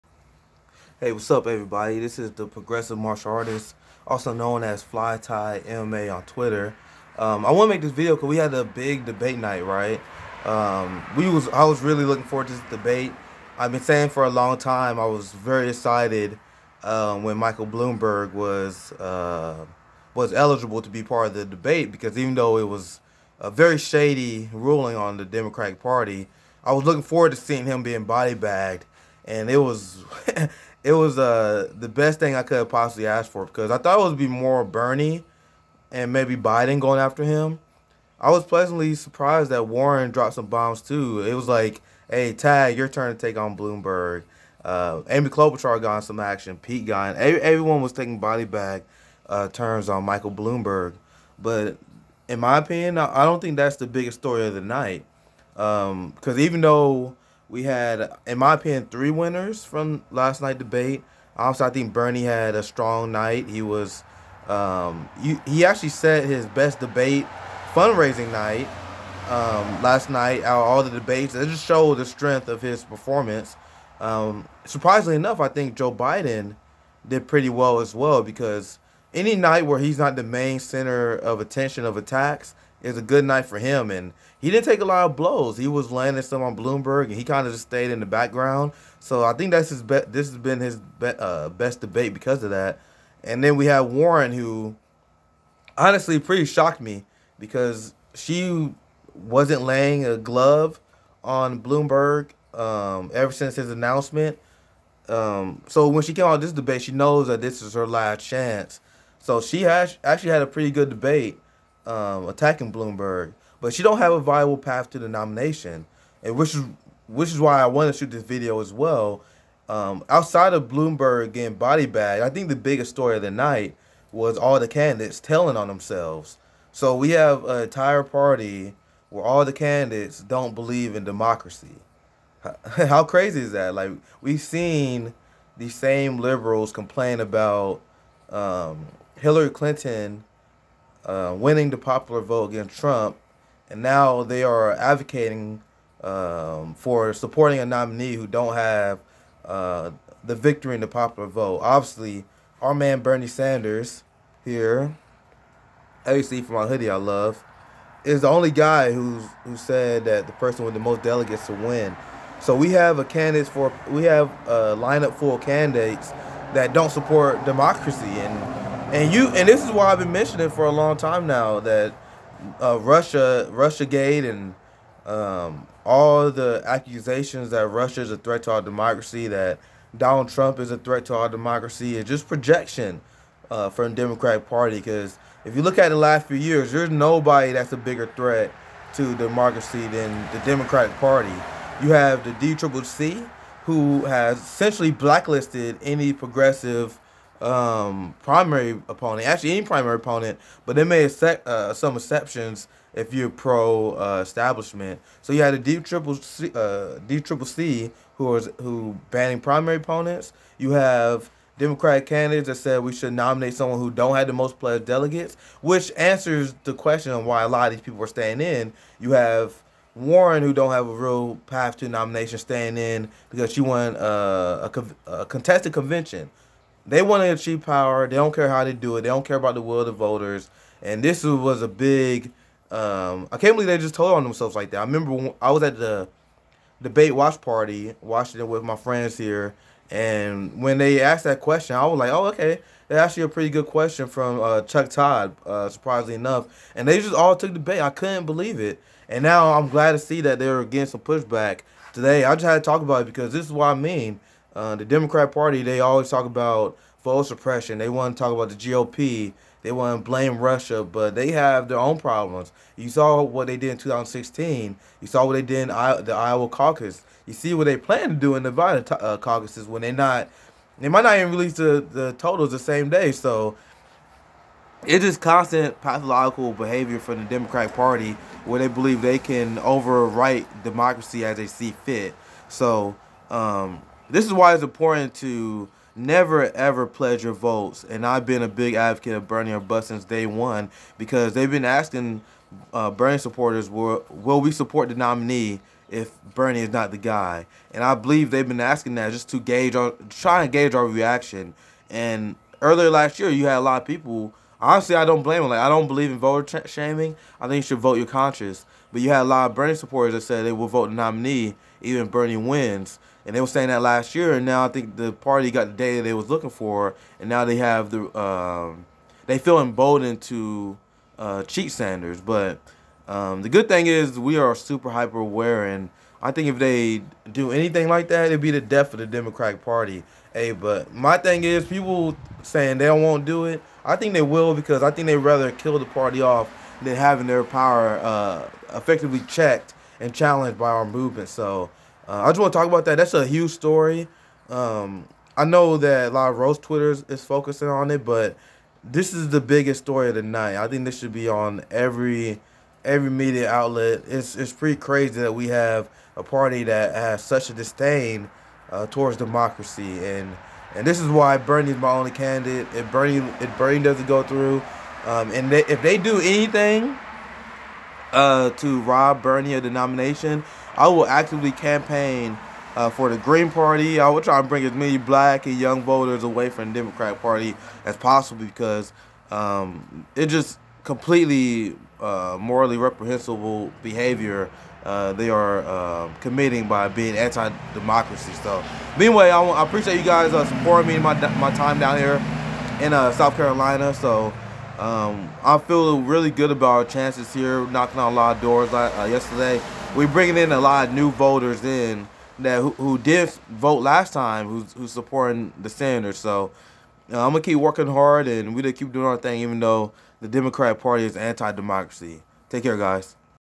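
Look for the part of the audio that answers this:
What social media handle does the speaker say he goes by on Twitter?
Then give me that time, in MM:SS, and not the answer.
00:04.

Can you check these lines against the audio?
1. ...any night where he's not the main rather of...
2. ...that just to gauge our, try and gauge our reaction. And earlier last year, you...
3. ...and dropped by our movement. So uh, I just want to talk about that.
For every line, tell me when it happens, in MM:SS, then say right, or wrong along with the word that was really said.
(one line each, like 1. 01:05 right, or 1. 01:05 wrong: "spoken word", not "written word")
1. 01:19 wrong: "center", not "rather"
2. 04:58 right
3. 05:39 wrong: "challenged", not "dropped".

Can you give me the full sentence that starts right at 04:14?
Uh, the Democrat Party, they always talk about voter suppression.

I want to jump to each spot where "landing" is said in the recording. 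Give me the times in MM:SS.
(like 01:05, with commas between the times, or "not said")
01:25.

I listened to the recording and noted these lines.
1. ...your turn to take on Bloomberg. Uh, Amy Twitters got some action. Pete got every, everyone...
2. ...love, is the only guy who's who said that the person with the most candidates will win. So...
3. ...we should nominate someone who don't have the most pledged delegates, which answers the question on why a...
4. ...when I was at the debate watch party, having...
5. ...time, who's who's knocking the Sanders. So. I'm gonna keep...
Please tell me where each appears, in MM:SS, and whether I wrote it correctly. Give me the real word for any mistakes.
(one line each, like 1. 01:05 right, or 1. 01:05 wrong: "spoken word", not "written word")
1. 00:42 wrong: "Klobuchar", not "Twitters"
2. 02:36 wrong: "delegates", not "candidates"
3. 03:32 right
4. 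03:55 wrong: "watching", not "having"
5. 06:44 wrong: "supporting", not "knocking".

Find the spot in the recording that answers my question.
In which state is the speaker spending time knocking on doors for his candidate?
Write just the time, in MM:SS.
06:33.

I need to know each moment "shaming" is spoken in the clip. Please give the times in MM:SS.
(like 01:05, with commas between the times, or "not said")
05:06.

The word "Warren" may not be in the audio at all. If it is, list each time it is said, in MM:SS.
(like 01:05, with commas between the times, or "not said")
00:39, 01:33, 03:39.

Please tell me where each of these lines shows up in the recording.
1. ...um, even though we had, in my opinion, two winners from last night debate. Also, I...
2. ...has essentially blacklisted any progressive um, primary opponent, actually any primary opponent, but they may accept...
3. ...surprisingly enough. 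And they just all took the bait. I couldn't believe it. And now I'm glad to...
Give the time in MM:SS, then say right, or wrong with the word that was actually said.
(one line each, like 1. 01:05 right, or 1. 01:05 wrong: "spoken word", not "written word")
1. 00:56 wrong: "three", not "two"
2. 03:14 right
3. 04:05 right.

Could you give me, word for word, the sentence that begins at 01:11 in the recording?
It just showed the strength of his performance.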